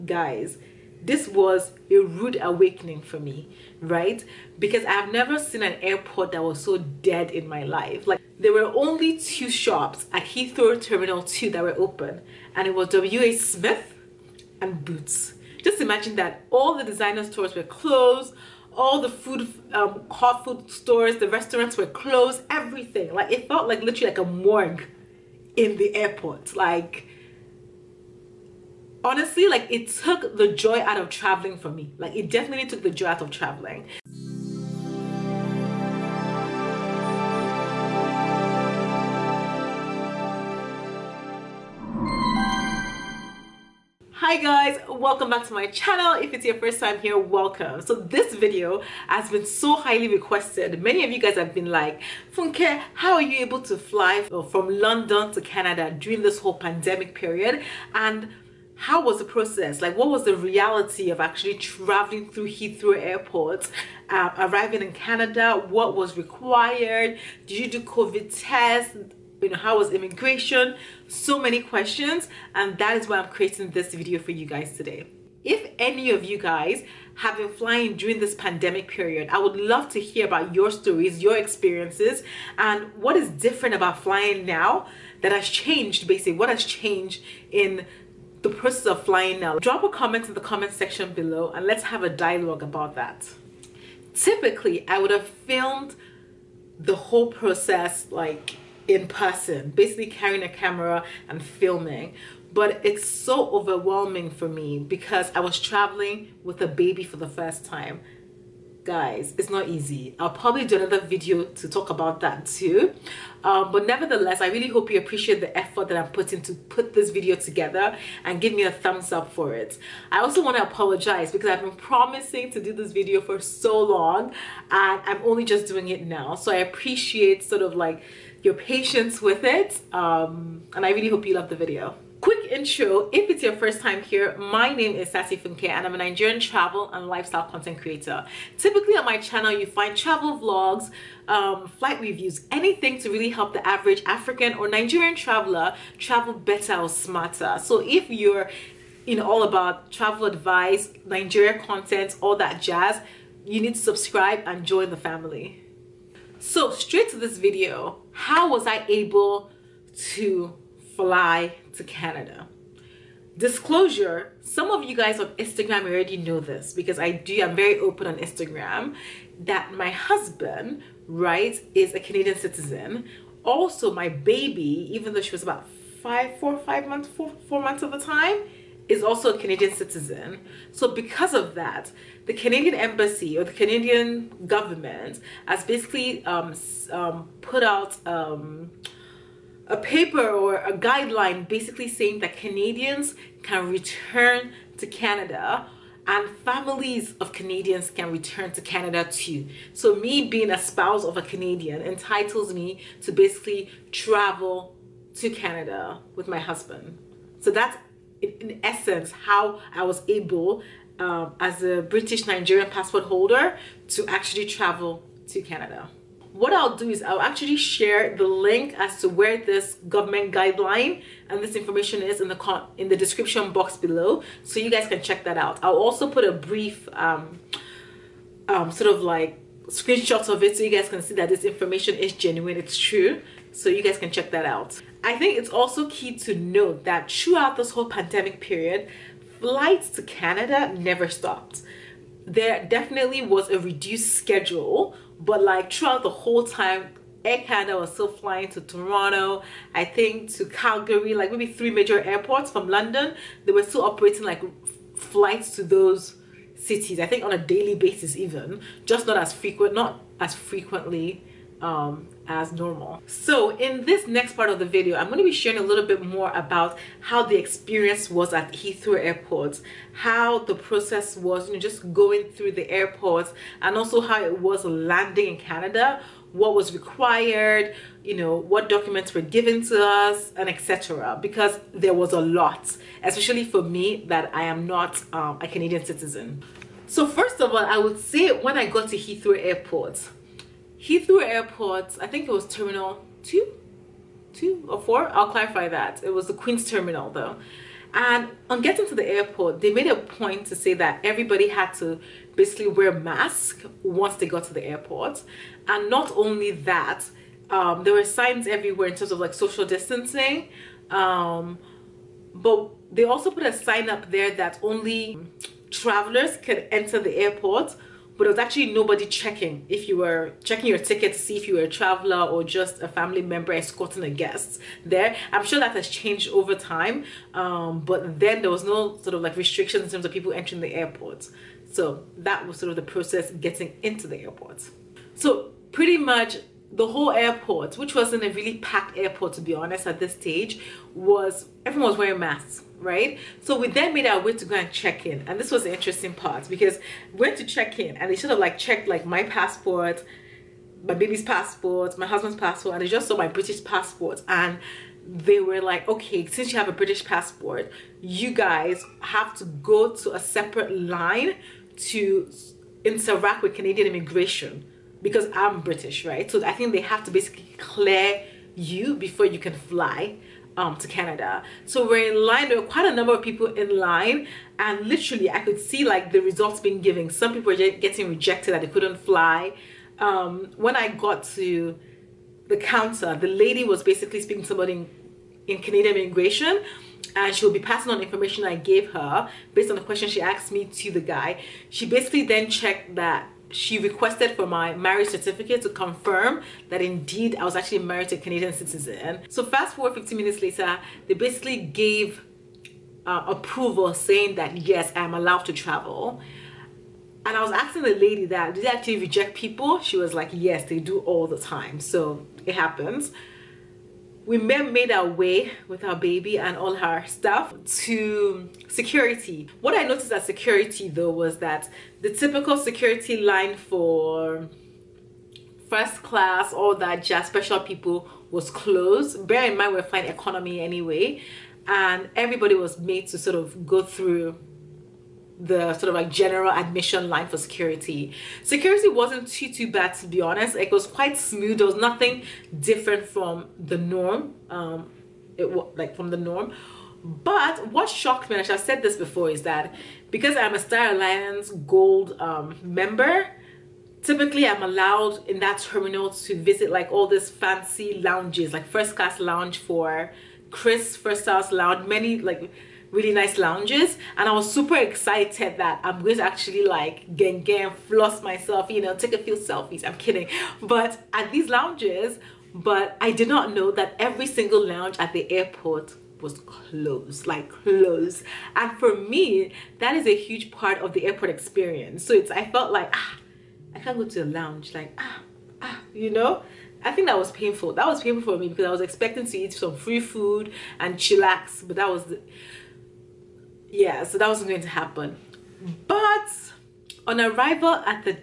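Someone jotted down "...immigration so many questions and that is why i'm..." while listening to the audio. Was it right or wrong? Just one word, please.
right.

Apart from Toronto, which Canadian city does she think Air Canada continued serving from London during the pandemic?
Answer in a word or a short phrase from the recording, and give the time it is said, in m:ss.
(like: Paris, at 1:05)
Calgary, at 4:10.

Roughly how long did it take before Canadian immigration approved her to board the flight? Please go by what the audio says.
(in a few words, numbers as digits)
15 minutes.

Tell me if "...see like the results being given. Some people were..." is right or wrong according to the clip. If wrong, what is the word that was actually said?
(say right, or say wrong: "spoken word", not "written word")
right.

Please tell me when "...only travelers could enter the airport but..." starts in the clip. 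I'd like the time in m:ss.
5:14.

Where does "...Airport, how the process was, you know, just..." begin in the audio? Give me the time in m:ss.
4:28.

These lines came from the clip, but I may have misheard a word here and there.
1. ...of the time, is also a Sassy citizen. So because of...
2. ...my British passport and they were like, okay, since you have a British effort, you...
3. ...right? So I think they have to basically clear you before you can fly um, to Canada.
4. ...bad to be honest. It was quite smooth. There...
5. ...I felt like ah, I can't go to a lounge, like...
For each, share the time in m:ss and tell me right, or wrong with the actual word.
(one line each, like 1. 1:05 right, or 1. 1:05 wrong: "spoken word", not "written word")
1. 2:57 wrong: "Canadian", not "Sassy"
2. 5:53 wrong: "passport", not "effort"
3. 6:06 right
4. 7:19 right
5. 8:02 right.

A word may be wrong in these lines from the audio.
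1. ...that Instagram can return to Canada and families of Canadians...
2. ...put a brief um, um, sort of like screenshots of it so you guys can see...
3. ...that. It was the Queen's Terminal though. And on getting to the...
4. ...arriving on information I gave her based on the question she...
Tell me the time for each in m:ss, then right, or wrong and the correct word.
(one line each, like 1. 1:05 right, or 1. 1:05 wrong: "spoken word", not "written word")
1. 3:12 wrong: "Canadians", not "Instagram"
2. 3:46 right
3. 4:55 right
4. 6:27 wrong: "passing", not "arriving".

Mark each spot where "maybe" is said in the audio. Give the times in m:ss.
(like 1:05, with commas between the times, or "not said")
4:11.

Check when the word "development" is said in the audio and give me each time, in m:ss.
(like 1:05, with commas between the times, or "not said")
not said.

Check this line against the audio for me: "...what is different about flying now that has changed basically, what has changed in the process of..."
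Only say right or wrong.
right.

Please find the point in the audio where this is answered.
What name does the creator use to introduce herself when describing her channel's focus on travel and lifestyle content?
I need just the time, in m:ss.
2:15.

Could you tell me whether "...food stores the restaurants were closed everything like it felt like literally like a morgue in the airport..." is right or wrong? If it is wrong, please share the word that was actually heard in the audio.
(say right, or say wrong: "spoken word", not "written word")
right.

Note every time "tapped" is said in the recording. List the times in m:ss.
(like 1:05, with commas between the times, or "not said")
not said.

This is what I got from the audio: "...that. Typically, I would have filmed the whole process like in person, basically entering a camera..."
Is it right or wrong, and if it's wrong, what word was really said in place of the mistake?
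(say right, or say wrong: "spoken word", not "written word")
wrong: "carrying", not "entering".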